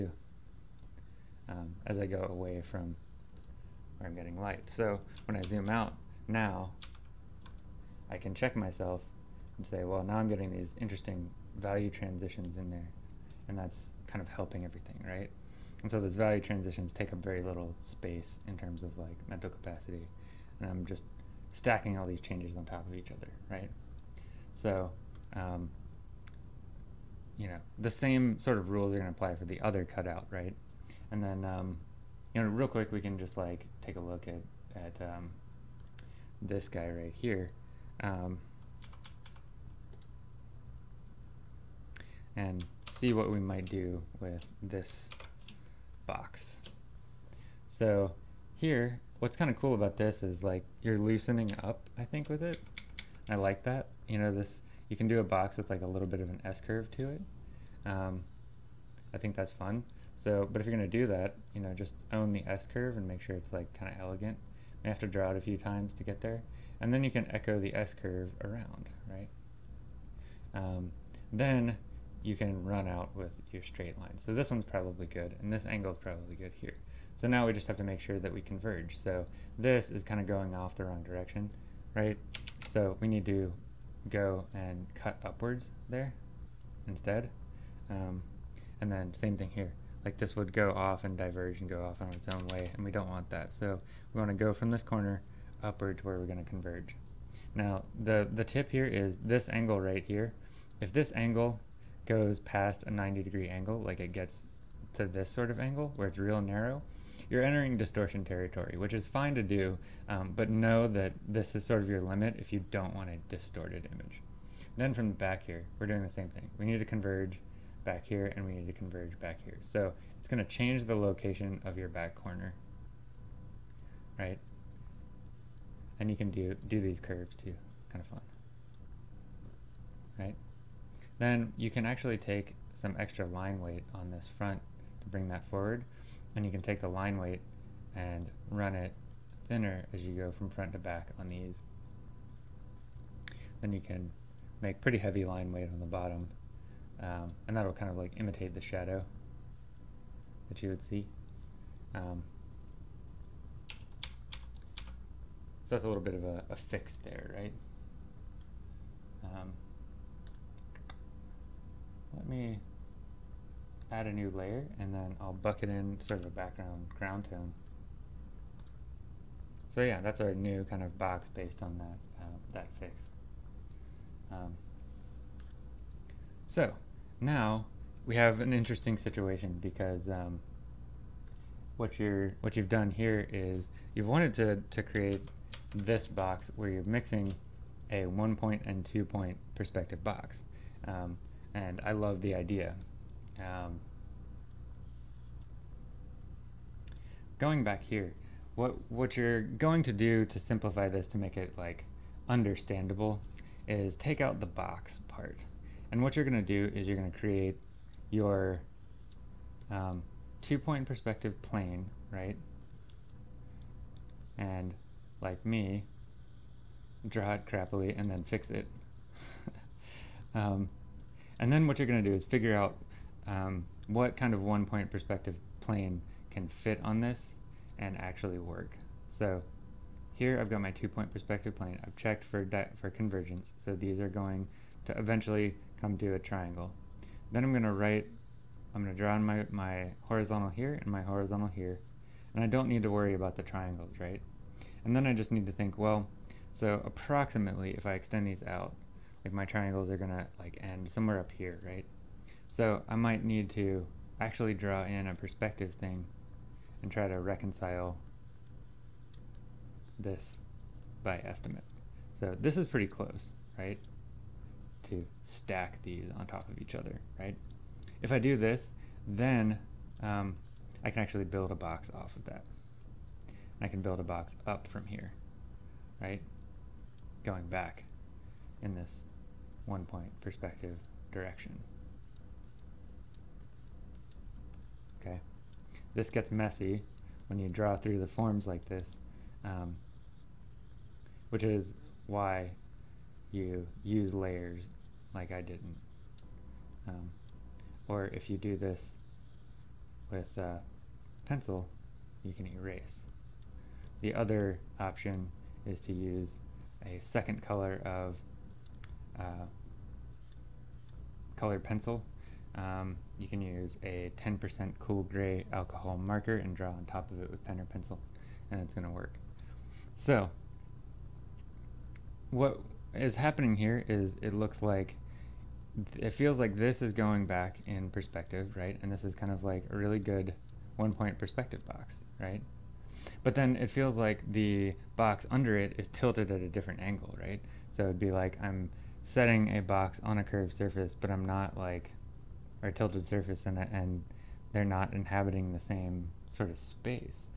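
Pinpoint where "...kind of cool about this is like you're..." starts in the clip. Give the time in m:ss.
0:49.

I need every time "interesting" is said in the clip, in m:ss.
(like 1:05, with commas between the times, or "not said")
0:10, 2:58.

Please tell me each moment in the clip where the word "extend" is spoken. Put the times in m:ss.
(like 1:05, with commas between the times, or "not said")
4:07.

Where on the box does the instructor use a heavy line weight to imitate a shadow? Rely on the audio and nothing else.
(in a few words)
The bottom.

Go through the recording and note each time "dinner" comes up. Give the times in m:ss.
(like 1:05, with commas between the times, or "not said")
not said.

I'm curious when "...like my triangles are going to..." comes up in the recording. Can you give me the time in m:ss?
4:09.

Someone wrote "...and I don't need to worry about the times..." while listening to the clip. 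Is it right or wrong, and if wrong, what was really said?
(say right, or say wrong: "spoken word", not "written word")
wrong: "triangles", not "times".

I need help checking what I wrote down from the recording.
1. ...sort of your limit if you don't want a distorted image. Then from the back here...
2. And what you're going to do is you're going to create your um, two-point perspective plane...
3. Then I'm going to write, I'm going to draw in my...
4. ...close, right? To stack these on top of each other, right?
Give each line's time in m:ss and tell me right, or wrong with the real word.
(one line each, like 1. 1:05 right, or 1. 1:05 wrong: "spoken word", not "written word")
1. 1:51 right
2. 3:25 right
3. 3:57 right
4. 4:22 right.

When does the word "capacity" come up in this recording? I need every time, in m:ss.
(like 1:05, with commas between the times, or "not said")
0:19.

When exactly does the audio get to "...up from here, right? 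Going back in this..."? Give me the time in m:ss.
4:34.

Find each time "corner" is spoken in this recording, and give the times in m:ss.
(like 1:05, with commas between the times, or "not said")
1:34, 2:02.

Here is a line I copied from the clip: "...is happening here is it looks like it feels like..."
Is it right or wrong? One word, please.
right.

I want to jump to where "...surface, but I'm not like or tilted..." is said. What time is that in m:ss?
5:40.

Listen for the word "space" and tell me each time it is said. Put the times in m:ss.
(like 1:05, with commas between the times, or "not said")
0:17, 5:46.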